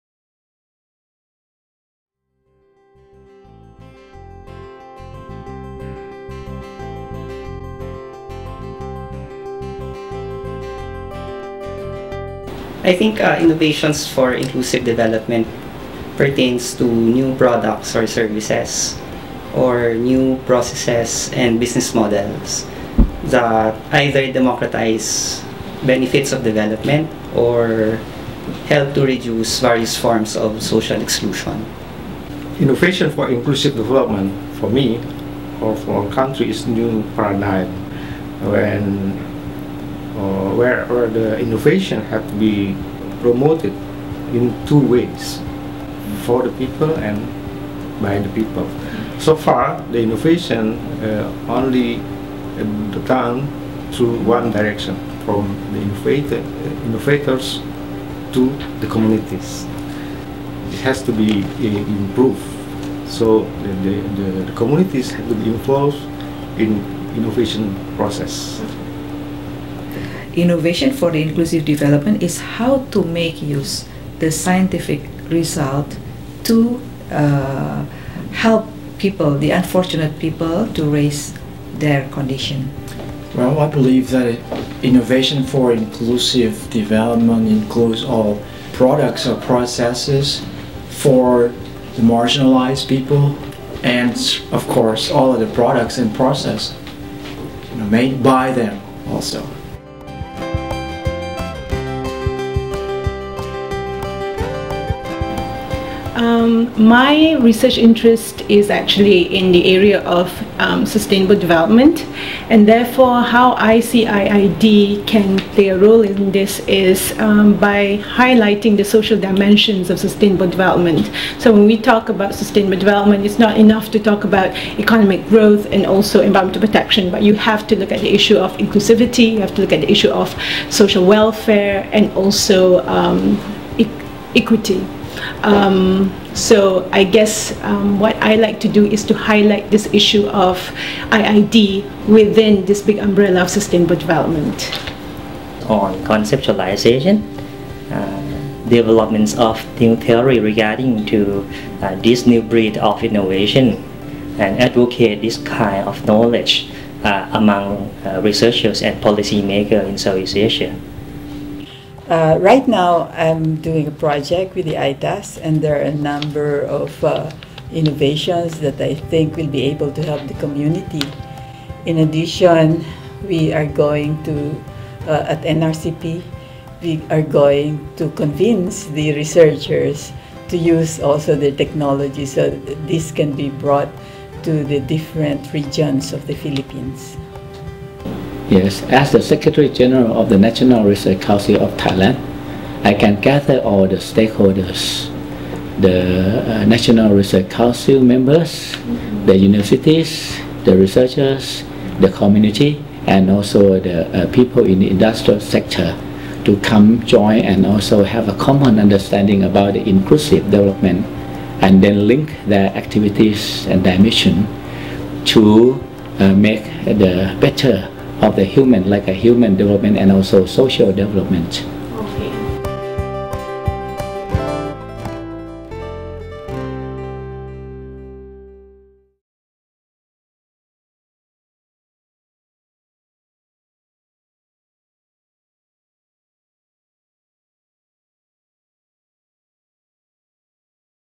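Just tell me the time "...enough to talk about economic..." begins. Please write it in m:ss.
2:03.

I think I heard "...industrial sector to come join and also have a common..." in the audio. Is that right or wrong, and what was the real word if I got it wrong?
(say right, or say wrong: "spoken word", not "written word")
right.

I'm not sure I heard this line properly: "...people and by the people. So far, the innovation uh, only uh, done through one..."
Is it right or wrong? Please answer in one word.
right.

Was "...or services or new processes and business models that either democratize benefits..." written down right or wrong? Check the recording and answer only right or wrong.
right.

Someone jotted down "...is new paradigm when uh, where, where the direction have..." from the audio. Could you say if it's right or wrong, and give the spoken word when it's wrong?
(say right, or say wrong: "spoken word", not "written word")
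wrong: "innovation", not "direction".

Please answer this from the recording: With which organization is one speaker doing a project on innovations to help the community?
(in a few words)
ITAS.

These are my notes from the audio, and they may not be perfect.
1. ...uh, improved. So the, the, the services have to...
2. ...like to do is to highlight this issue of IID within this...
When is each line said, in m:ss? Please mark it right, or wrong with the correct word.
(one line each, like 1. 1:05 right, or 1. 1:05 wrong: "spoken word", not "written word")
1. 1:01 wrong: "communities", not "services"
2. 2:18 right.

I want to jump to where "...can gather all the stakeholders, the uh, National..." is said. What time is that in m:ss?
3:13.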